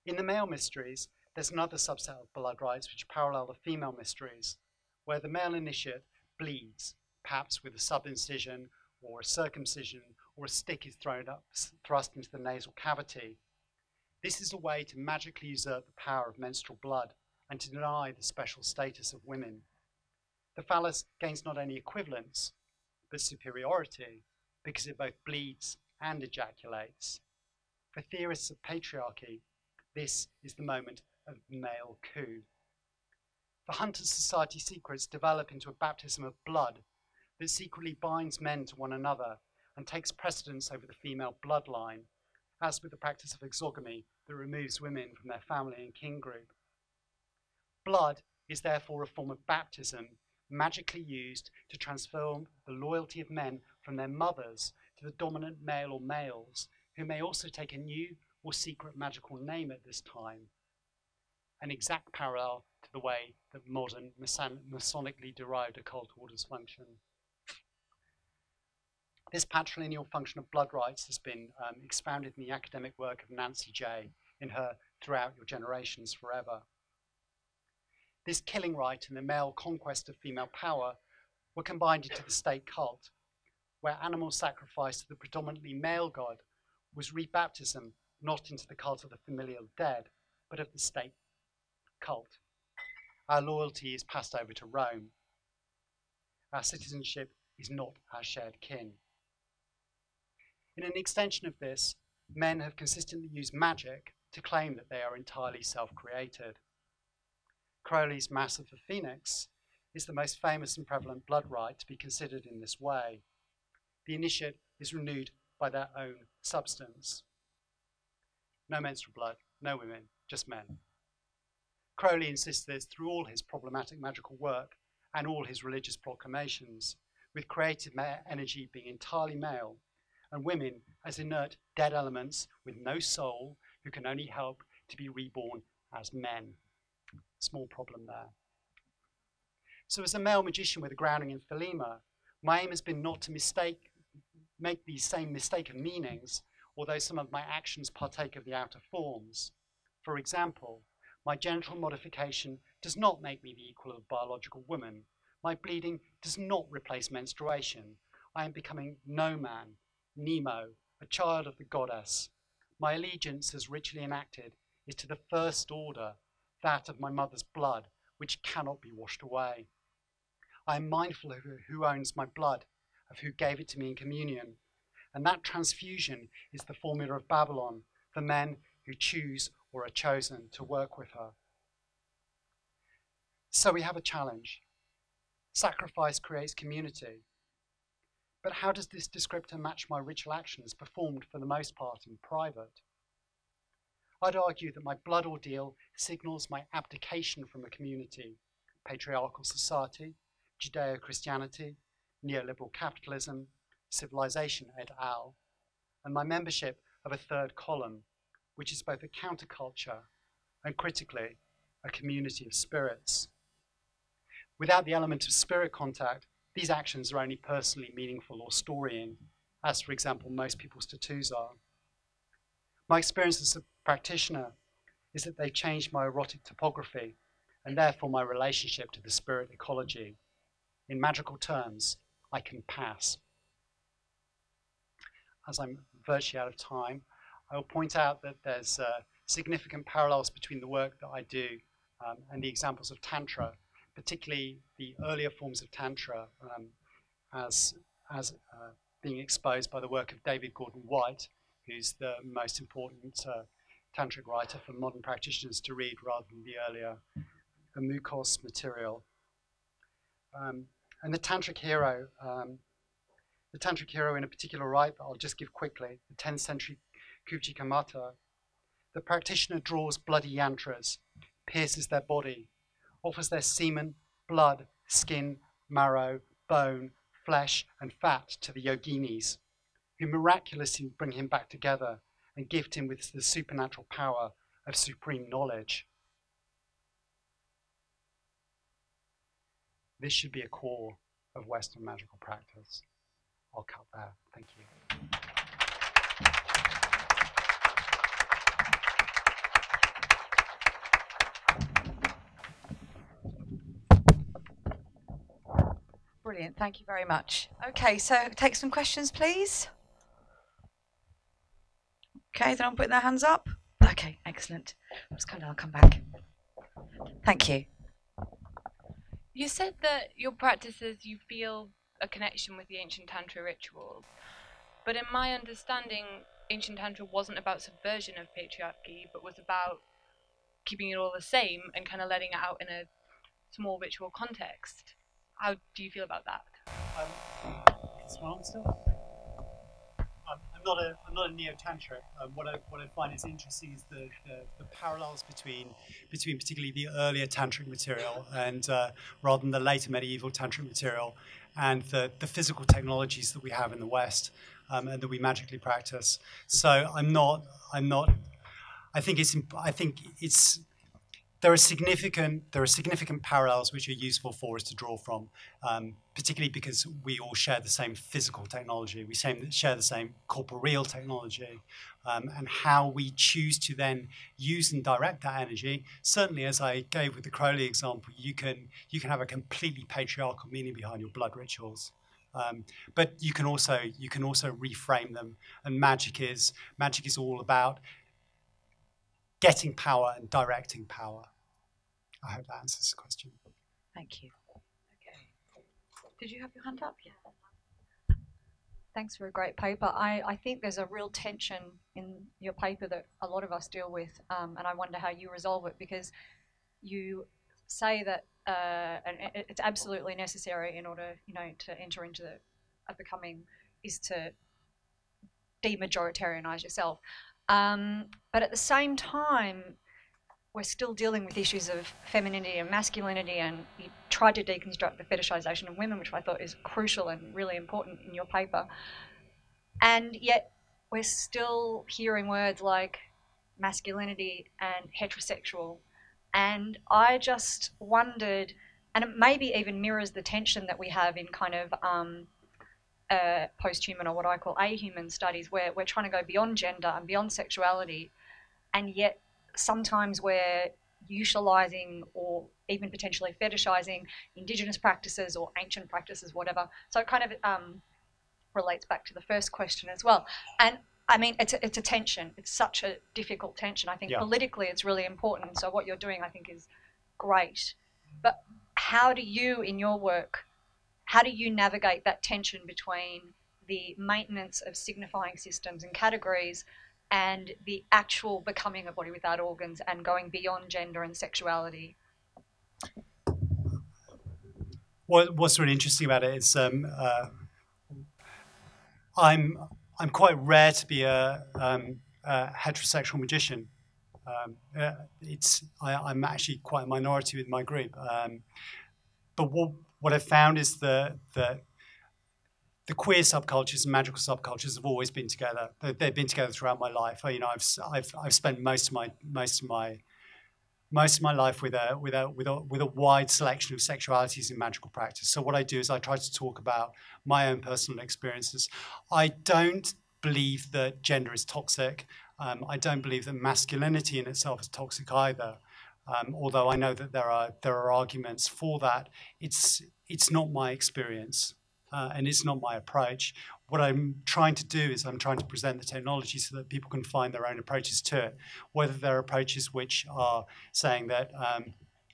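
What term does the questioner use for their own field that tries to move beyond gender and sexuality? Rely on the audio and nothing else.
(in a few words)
ahuman studies.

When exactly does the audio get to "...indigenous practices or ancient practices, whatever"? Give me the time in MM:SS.
07:34.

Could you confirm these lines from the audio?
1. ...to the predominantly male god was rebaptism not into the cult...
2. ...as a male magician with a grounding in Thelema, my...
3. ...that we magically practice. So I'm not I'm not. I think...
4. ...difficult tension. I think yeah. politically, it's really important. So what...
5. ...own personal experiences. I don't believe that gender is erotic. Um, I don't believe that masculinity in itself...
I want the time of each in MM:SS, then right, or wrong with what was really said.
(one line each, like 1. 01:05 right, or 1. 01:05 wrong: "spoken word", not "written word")
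1. 01:24 right
2. 02:20 right
3. 05:55 right
4. 07:43 right
5. 08:37 wrong: "toxic", not "erotic".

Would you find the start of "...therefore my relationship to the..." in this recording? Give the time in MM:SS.
03:47.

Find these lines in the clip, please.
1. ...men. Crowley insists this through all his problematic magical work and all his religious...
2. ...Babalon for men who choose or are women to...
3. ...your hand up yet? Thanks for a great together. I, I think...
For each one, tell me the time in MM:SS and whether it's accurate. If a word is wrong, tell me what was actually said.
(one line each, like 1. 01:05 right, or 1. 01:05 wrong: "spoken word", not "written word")
1. 02:00 right
2. 02:57 wrong: "chosen", not "women"
3. 06:36 wrong: "paper", not "together".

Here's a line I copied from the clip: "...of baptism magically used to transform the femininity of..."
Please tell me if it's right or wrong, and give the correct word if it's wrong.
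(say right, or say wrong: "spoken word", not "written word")
wrong: "loyalty", not "femininity".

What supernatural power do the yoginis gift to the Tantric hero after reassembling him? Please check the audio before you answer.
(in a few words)
supreme knowledge.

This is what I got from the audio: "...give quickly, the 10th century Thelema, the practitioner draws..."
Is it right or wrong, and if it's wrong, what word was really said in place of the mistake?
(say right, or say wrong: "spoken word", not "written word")
wrong: "Kamata", not "Thelema".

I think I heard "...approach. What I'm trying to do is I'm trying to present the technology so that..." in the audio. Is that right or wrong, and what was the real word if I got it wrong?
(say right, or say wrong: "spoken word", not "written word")
right.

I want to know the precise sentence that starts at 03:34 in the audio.
Without the element of spirit contact, these actions are only personally meaningful or storying, as for example most people's tattoos are.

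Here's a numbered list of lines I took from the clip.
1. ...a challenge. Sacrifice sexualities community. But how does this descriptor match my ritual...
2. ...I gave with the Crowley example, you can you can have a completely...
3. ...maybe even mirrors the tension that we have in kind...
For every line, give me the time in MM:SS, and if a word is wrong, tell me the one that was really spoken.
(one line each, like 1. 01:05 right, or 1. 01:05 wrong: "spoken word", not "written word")
1. 03:03 wrong: "creates", not "sexualities"
2. 06:16 right
3. 07:19 right.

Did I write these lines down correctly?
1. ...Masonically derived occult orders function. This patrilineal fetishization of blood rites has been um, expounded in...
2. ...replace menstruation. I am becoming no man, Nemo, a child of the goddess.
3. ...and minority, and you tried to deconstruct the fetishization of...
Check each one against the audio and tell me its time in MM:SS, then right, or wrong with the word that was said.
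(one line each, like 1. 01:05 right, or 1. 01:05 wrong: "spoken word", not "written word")
1. 01:04 wrong: "function", not "fetishization"
2. 02:36 right
3. 07:02 wrong: "masculinity", not "minority".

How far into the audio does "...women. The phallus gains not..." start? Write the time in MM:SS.
00:19.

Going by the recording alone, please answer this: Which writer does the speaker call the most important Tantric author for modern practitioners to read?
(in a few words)
David Gordon White.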